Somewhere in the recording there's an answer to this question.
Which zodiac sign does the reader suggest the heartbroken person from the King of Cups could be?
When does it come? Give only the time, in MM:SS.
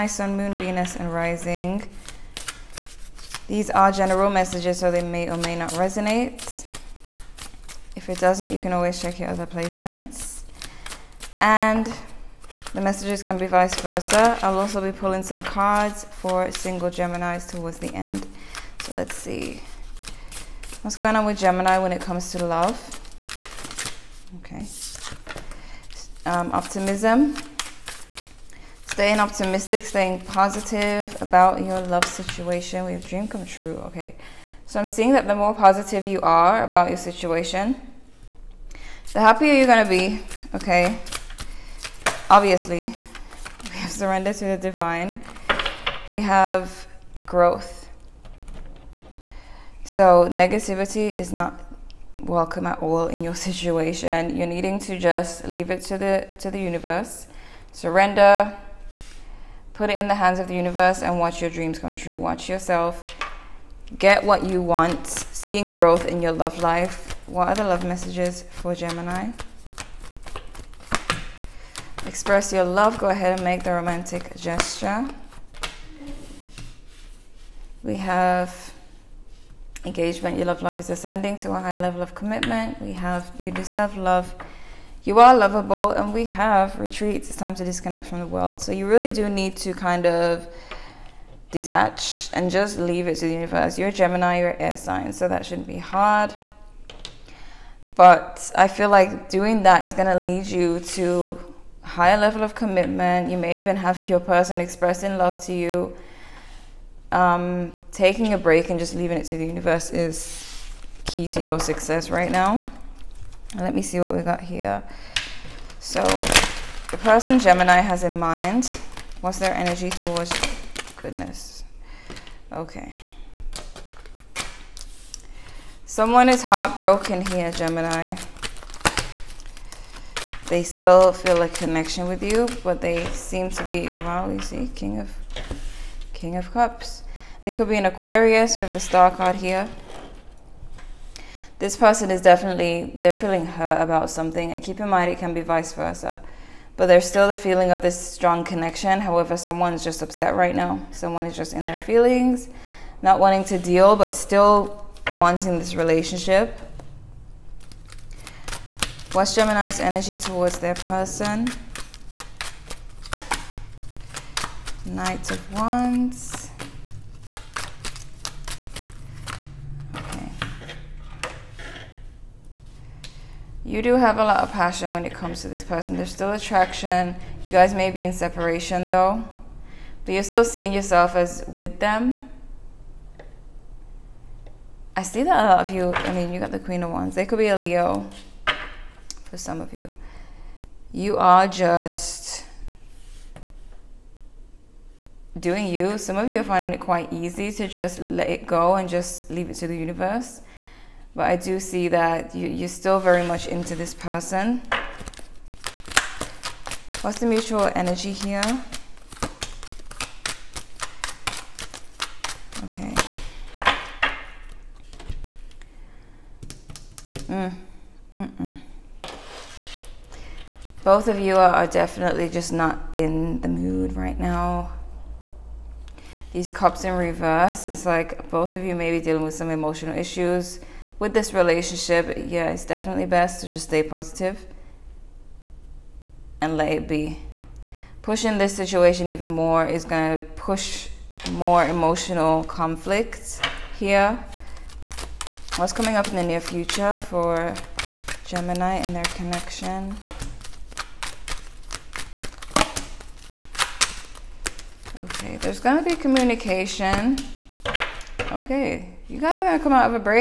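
02:17.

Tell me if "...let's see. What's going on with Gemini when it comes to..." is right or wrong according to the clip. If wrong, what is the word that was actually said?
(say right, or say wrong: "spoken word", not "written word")
right.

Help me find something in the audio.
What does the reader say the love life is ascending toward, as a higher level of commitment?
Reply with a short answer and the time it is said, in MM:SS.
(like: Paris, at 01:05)
Engagement, at 01:19.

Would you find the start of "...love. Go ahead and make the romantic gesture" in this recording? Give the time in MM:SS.
01:12.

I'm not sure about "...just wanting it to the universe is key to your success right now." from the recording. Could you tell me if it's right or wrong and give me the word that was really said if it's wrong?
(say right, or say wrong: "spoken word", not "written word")
wrong: "leaving", not "wanting".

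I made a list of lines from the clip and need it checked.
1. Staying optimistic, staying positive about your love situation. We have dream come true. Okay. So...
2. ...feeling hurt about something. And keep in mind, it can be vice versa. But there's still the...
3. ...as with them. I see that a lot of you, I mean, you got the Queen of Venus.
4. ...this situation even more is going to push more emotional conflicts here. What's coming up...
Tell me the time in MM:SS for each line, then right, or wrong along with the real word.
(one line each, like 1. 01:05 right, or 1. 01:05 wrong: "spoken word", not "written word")
1. 00:28 right
2. 02:23 right
3. 03:01 wrong: "Wands", not "Venus"
4. 03:58 right.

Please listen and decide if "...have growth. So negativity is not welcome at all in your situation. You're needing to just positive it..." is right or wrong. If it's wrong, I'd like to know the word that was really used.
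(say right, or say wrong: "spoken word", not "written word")
wrong: "leave", not "positive".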